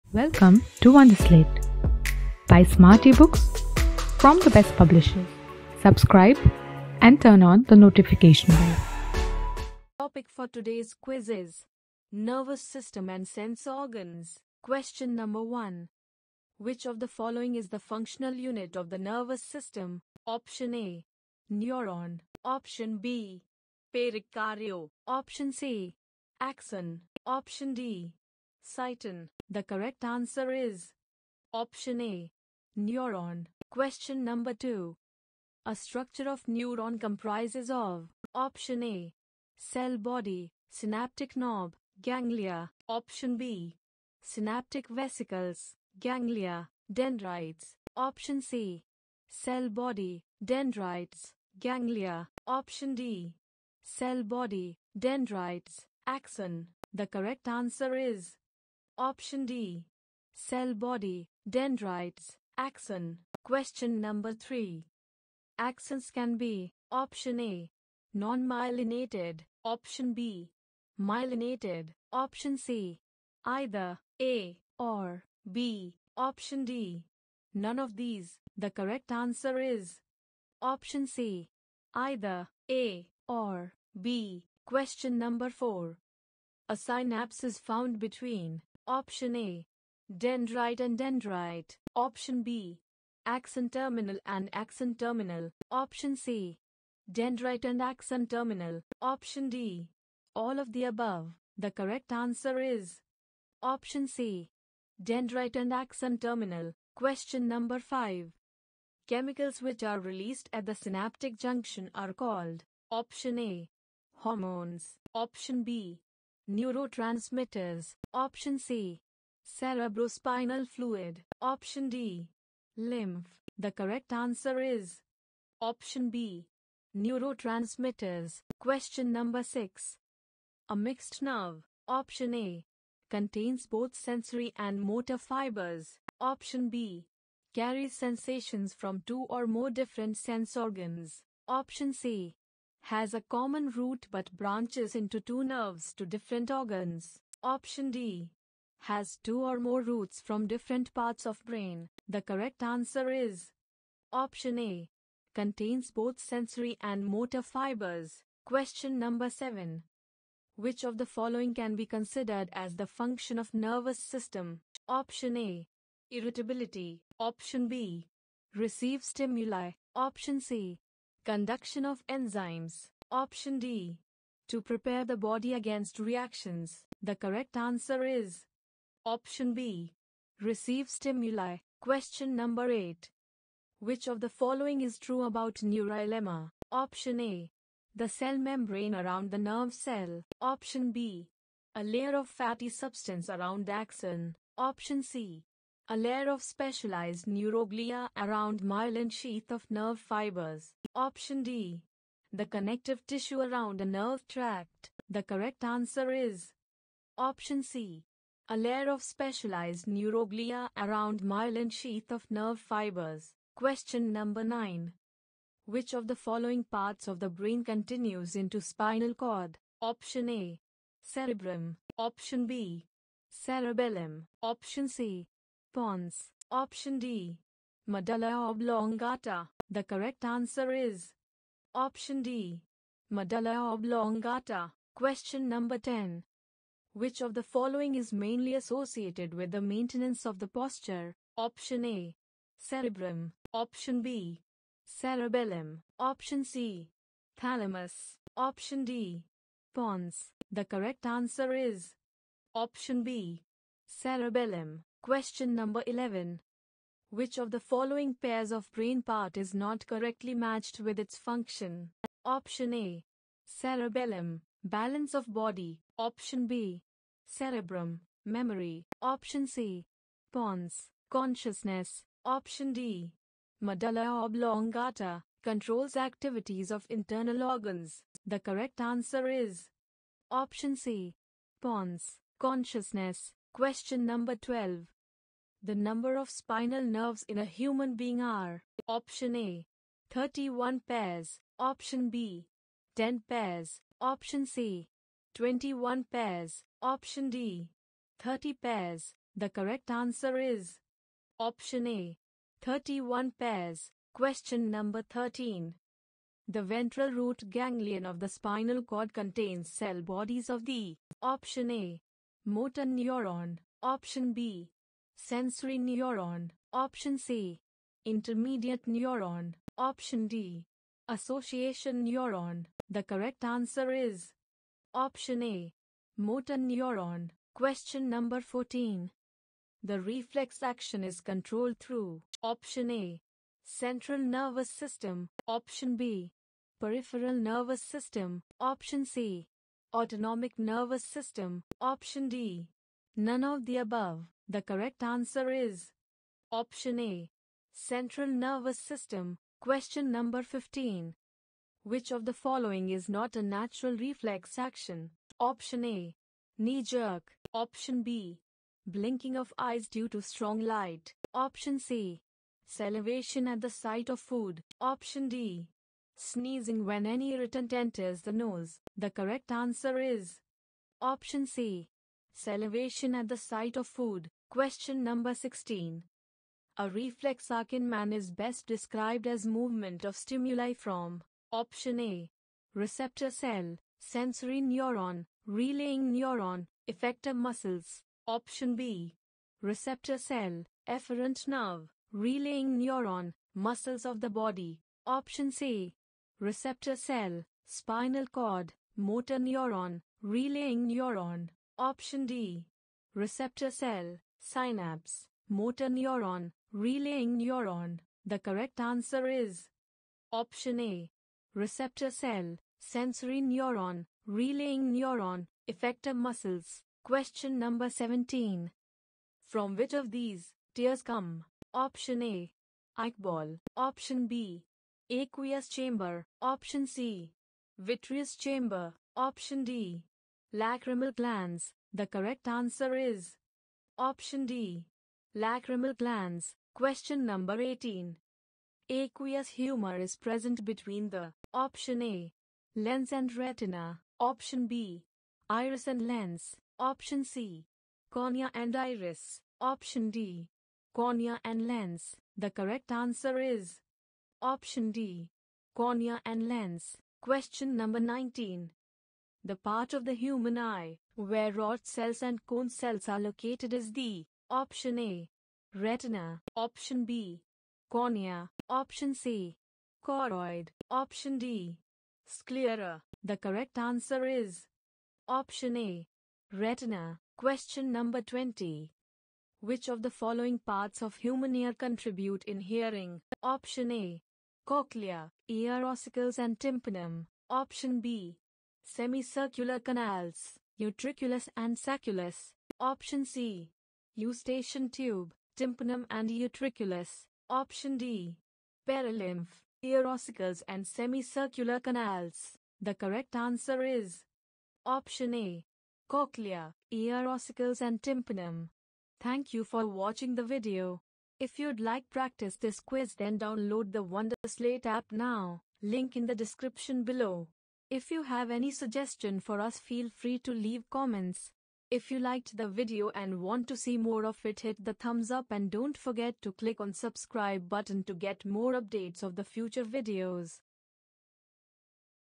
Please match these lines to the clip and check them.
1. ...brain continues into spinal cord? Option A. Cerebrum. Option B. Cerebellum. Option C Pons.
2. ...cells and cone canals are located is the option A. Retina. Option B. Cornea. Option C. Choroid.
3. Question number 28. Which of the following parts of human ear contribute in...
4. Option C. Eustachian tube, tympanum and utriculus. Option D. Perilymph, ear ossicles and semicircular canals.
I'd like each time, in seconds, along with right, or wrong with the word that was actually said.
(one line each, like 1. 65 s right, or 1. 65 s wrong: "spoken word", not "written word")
1. 217 s right
2. 461 s wrong: "cells", not "canals"
3. 477 s wrong: "20", not "28"
4. 492 s right.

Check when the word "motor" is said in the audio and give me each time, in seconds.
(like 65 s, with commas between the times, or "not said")
134 s, 157 s, 312 s, 326 s, 398 s, 405 s.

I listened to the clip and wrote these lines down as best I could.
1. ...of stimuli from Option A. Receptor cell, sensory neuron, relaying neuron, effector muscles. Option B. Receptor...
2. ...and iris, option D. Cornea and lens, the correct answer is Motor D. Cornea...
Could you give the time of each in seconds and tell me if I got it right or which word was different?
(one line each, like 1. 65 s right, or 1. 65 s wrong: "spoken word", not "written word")
1. 380 s right
2. 448 s wrong: "Option", not "Motor".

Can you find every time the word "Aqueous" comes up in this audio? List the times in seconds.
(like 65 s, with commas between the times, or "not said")
425 s, 438 s.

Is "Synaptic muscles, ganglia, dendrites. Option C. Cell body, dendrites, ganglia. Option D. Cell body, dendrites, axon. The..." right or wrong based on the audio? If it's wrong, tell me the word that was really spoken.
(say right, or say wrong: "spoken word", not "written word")
wrong: "vesicles", not "muscles".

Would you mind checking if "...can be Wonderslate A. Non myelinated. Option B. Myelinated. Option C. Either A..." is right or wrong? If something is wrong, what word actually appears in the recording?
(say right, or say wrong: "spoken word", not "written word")
wrong: "Option", not "Wonderslate".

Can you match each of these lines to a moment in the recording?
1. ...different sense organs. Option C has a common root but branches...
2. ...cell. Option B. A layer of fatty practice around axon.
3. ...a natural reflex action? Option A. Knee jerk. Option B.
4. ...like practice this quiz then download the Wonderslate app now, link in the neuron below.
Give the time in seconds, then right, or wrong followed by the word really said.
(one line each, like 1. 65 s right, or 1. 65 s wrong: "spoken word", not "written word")
1. 139 s right
2. 189 s wrong: "substance", not "practice"
3. 353 s right
4. 511 s wrong: "description", not "neuron".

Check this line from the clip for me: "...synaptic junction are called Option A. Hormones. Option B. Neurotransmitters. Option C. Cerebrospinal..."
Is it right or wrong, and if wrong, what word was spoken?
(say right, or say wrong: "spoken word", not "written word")
right.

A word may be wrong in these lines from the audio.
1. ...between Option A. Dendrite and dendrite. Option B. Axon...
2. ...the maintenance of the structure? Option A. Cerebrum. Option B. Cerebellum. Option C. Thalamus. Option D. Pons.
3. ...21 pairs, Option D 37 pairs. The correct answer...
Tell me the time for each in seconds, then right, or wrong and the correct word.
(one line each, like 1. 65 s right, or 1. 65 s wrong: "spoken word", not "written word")
1. 87 s right
2. 239 s wrong: "posture", not "structure"
3. 295 s wrong: "30", not "37".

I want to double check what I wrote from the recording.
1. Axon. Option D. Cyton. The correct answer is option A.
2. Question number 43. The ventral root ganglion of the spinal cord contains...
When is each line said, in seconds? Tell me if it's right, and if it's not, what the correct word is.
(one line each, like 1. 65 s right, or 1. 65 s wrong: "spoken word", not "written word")
1. 26 s right
2. 304 s wrong: "13", not "43".